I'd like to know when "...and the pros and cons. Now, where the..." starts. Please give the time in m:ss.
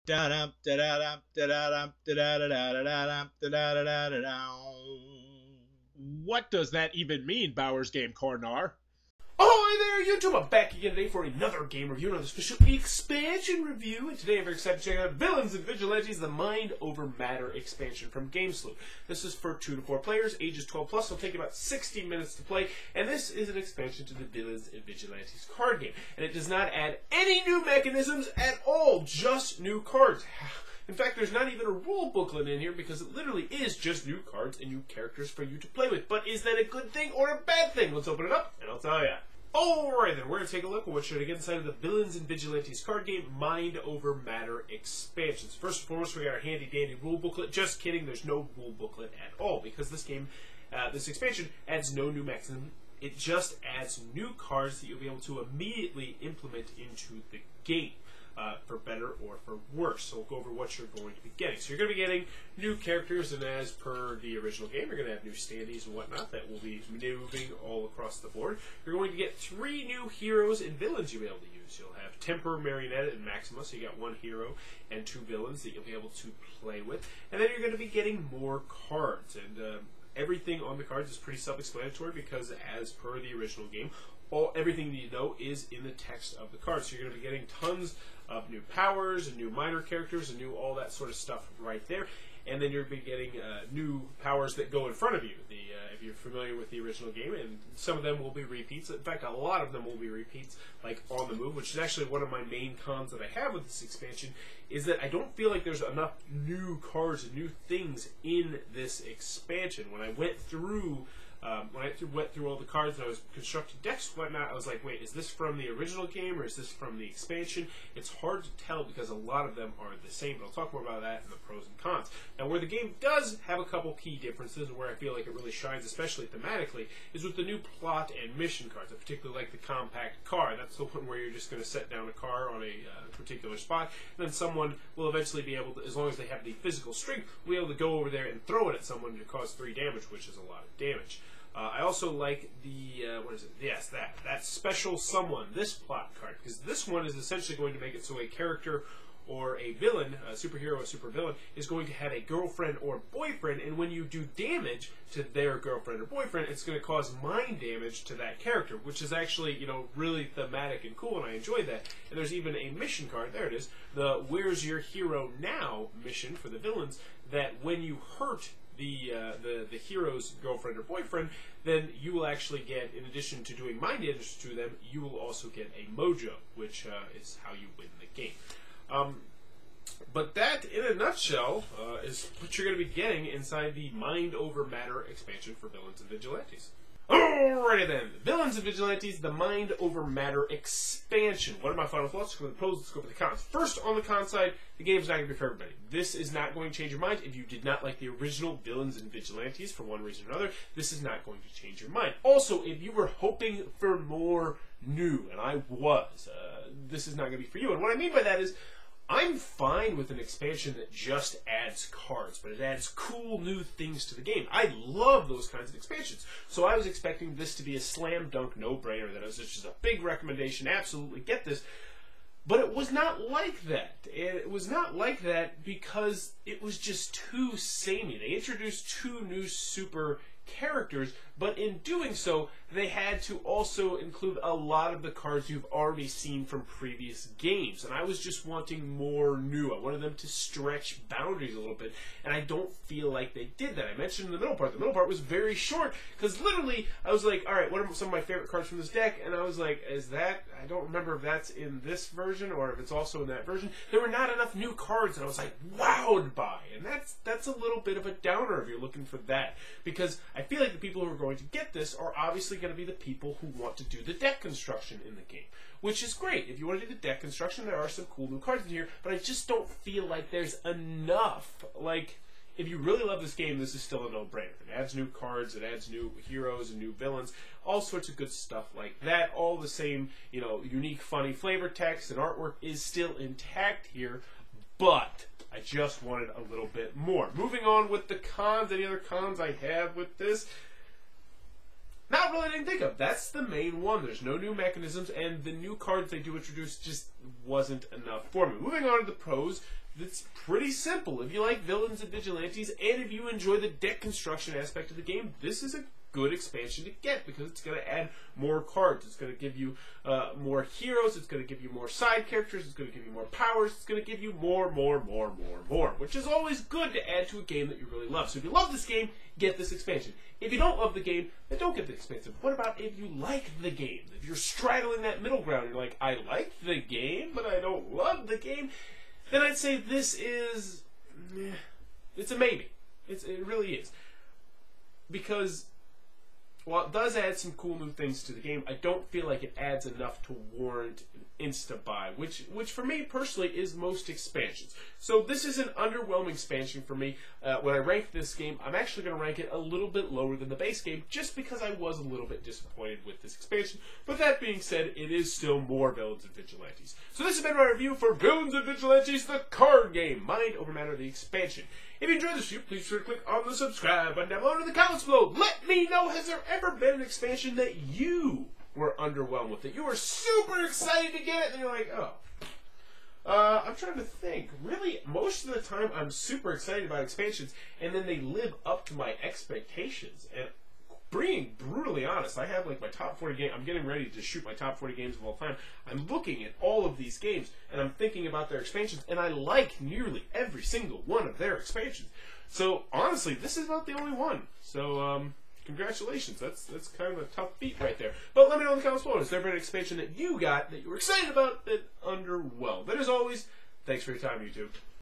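2:01.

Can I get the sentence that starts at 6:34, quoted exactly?
So um, Congratulations, that's that's kind of a tough feat right there.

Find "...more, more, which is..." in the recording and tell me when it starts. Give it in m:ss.
5:15.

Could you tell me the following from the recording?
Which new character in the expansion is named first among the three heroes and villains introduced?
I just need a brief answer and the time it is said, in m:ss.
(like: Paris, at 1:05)
Temper, at 1:12.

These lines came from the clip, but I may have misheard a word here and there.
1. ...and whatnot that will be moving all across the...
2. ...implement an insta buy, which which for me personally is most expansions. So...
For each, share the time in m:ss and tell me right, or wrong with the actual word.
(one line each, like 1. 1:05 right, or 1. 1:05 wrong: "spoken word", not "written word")
1. 1:05 right
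2. 5:40 wrong: "warrant", not "implement".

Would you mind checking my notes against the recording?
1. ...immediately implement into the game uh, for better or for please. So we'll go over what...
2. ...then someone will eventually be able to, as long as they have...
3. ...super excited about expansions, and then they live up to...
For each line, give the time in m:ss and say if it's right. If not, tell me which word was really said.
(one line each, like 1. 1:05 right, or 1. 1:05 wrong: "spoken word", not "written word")
1. 0:55 wrong: "worse", not "please"
2. 2:14 right
3. 6:16 right.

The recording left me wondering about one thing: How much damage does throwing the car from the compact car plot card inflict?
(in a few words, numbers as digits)
3.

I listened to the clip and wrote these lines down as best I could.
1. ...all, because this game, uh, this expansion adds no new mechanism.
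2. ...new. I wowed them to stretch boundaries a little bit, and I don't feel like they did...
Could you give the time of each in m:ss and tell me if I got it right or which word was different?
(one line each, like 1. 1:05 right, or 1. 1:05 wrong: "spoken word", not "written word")
1. 0:49 right
2. 3:59 wrong: "wanted", not "wowed".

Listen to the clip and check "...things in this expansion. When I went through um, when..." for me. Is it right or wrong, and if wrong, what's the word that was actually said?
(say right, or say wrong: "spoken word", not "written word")
right.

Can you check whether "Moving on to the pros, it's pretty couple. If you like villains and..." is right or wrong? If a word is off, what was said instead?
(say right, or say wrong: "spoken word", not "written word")
wrong: "simple", not "couple".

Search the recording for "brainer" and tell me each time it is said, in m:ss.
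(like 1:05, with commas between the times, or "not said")
3:38, 4:34.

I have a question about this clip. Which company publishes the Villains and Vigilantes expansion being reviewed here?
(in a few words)
Game Salute.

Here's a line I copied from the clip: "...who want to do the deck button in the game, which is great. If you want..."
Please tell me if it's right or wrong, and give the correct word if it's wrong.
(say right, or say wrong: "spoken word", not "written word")
wrong: "construction", not "button".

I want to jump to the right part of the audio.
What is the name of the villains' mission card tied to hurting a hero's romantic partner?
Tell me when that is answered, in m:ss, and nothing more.
2:44.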